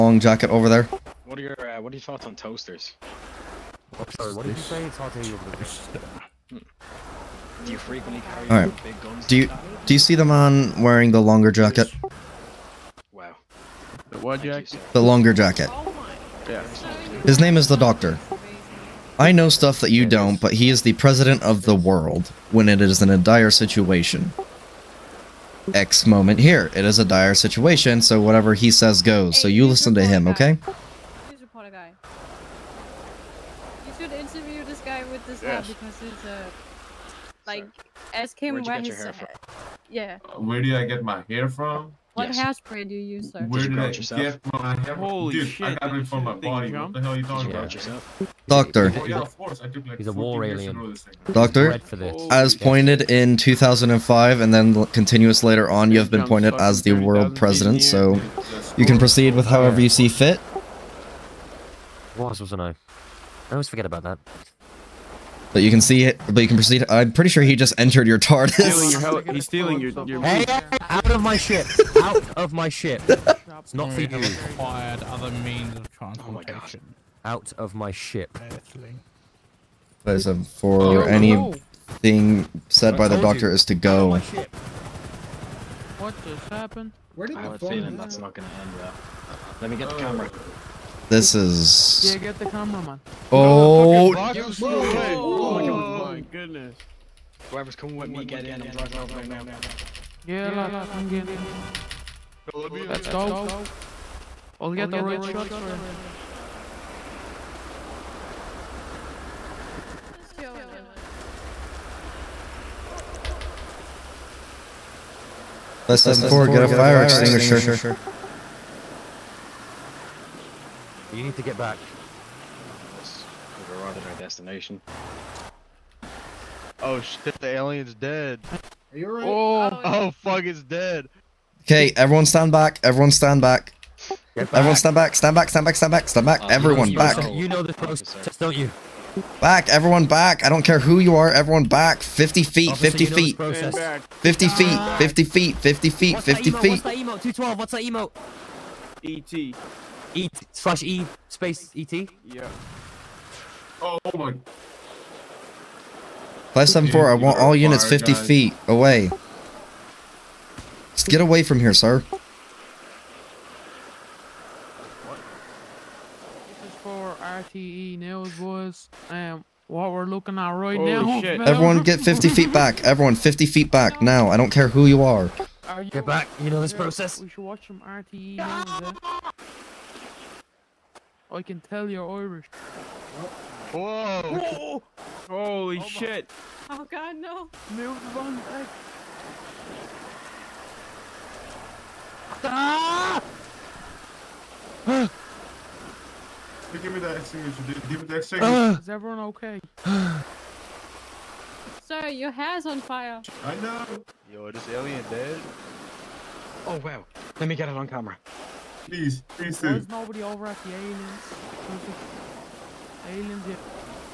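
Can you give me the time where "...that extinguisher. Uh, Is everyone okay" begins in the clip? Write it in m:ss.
3:18.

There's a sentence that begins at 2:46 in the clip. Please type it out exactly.
This is for RTE News, boys.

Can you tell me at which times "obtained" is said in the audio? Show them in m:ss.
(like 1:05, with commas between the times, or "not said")
not said.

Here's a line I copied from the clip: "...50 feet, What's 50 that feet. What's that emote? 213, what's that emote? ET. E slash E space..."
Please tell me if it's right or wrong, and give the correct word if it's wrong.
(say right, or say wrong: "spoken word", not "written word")
wrong: "212", not "213".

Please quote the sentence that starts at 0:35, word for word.
because he's a like, ask him Where'd where Yeah.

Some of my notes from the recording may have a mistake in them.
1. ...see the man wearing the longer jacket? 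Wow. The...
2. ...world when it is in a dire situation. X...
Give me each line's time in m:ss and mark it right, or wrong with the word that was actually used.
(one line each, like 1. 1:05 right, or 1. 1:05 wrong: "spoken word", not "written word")
1. 0:09 right
2. 0:21 right.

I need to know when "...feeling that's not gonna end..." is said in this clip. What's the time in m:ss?
1:27.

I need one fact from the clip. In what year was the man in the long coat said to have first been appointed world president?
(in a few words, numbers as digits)
2005.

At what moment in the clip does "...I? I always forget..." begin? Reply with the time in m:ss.
1:02.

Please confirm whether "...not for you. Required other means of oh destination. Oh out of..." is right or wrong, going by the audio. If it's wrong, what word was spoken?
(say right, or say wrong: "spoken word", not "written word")
wrong: "transportation", not "destination".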